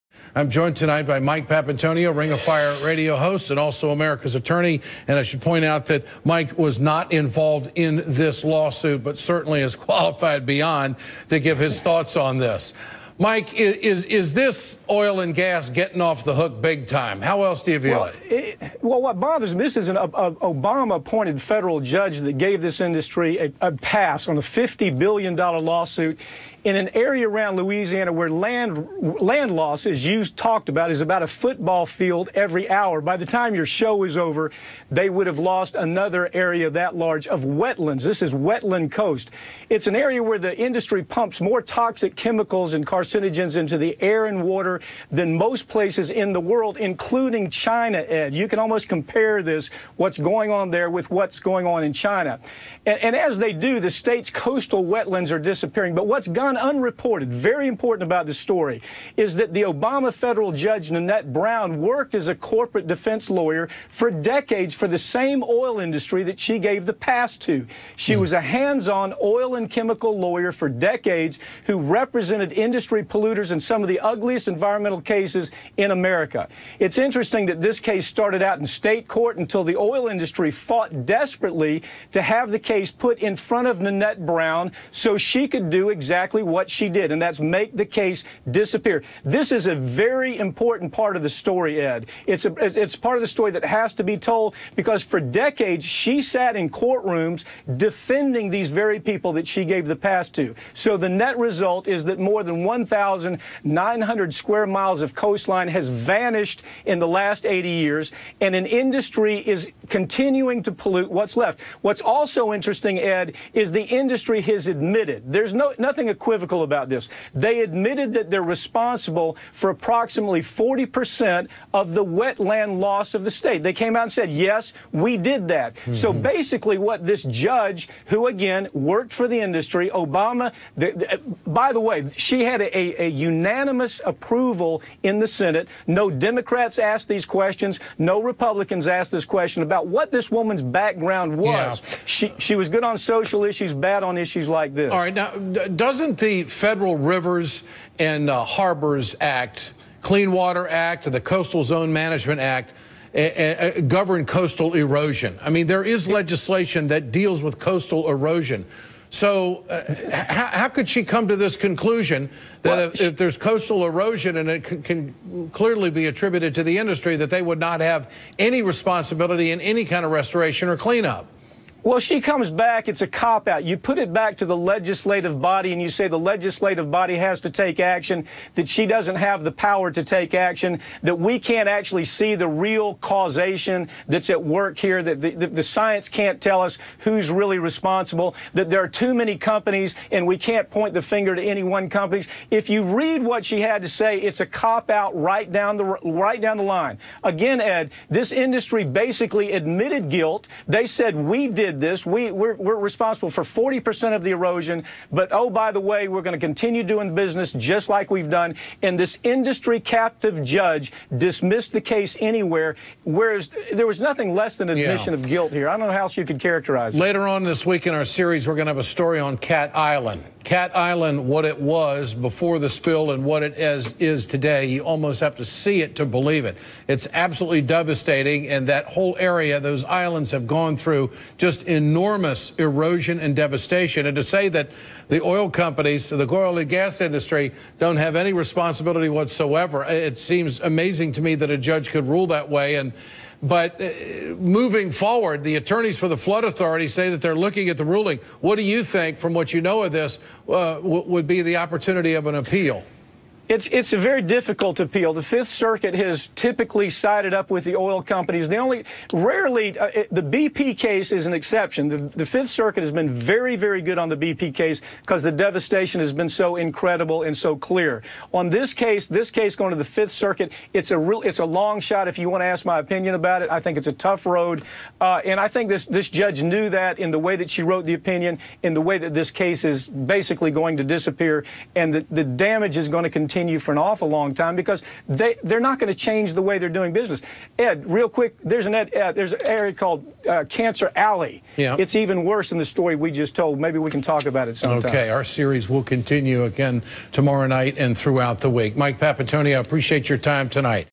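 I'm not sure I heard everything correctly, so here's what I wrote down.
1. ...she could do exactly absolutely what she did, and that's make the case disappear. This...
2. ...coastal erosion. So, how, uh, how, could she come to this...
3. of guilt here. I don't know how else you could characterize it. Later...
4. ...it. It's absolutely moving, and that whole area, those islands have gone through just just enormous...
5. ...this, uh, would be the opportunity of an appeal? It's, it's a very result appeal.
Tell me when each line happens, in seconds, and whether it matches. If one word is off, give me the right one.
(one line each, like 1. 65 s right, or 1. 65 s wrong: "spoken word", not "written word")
1. 85 s wrong: "exactly", not "absolutely"
2. 157 s right
3. 215 s right
4. 226 s wrong: "devastating", not "moving"
5. 249 s wrong: "difficult", not "result".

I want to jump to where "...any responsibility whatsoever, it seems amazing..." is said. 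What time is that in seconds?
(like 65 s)
238 s.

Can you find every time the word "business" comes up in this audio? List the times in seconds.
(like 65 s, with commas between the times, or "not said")
207 s, 286 s.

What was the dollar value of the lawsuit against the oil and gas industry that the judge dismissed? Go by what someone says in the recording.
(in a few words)
$50 billion.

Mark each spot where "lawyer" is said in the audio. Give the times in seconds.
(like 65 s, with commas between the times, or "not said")
63 s, 70 s.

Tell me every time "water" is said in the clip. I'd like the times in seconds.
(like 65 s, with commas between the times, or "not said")
44 s, 150 s.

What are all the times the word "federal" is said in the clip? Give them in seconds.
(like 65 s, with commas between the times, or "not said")
21 s, 60 s, 146 s.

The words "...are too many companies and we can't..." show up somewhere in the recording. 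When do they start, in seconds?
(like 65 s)
188 s.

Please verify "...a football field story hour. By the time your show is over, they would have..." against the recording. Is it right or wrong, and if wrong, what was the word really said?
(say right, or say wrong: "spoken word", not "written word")
wrong: "every", not "story".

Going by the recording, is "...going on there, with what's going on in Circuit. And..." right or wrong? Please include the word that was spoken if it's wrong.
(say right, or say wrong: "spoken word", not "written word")
wrong: "China", not "Circuit".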